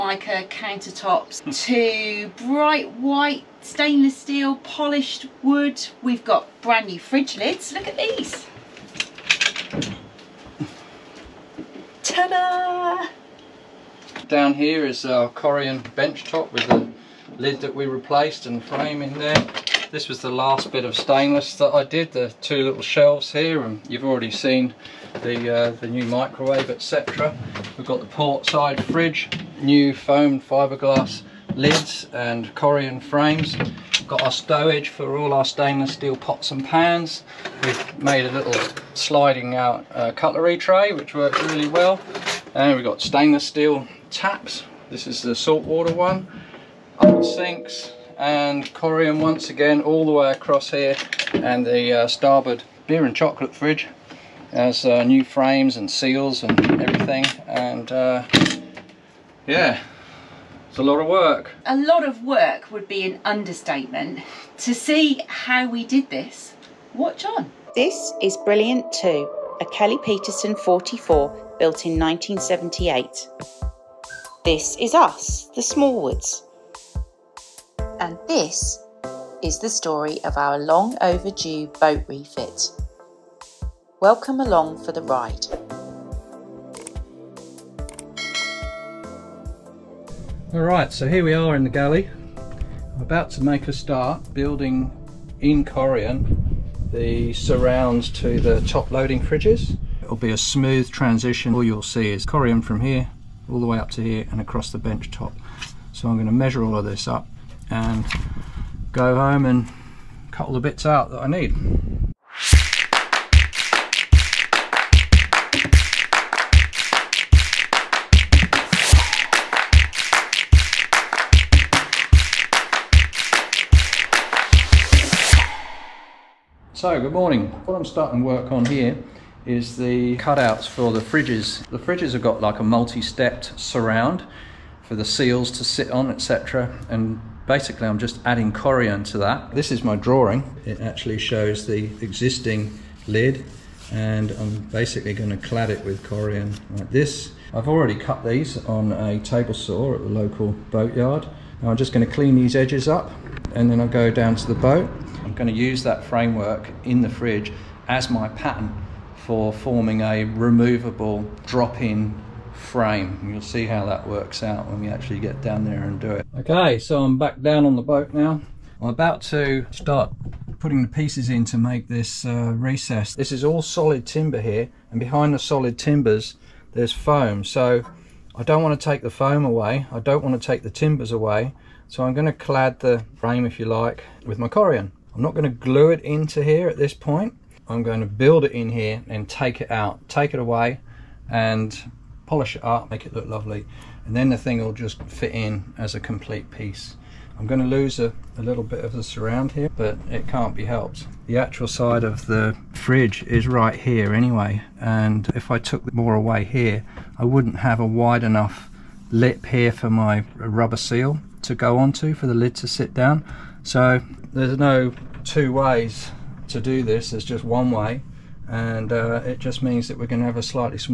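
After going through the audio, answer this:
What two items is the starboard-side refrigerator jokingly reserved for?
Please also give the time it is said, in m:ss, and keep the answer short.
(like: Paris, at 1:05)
Beer and chocolate, at 0:52.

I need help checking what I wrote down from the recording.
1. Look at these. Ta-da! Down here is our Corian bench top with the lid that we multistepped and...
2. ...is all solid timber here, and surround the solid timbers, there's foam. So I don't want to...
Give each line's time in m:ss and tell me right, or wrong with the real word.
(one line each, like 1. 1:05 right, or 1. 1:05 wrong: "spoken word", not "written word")
1. 0:07 wrong: "replaced", not "multistepped"
2. 2:53 wrong: "behind", not "surround".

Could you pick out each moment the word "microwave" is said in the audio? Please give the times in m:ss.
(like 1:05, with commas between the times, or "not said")
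0:26.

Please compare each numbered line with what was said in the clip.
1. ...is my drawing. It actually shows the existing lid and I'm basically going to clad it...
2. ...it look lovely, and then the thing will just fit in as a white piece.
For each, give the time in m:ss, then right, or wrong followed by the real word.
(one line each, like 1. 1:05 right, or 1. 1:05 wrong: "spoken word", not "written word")
1. 2:19 right
2. 3:13 wrong: "complete", not "white".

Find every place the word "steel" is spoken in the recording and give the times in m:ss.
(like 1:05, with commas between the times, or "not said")
0:04, 0:35, 0:43.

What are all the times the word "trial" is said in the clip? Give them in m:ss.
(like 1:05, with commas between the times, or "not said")
not said.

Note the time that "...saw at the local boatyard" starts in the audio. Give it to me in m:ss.
2:29.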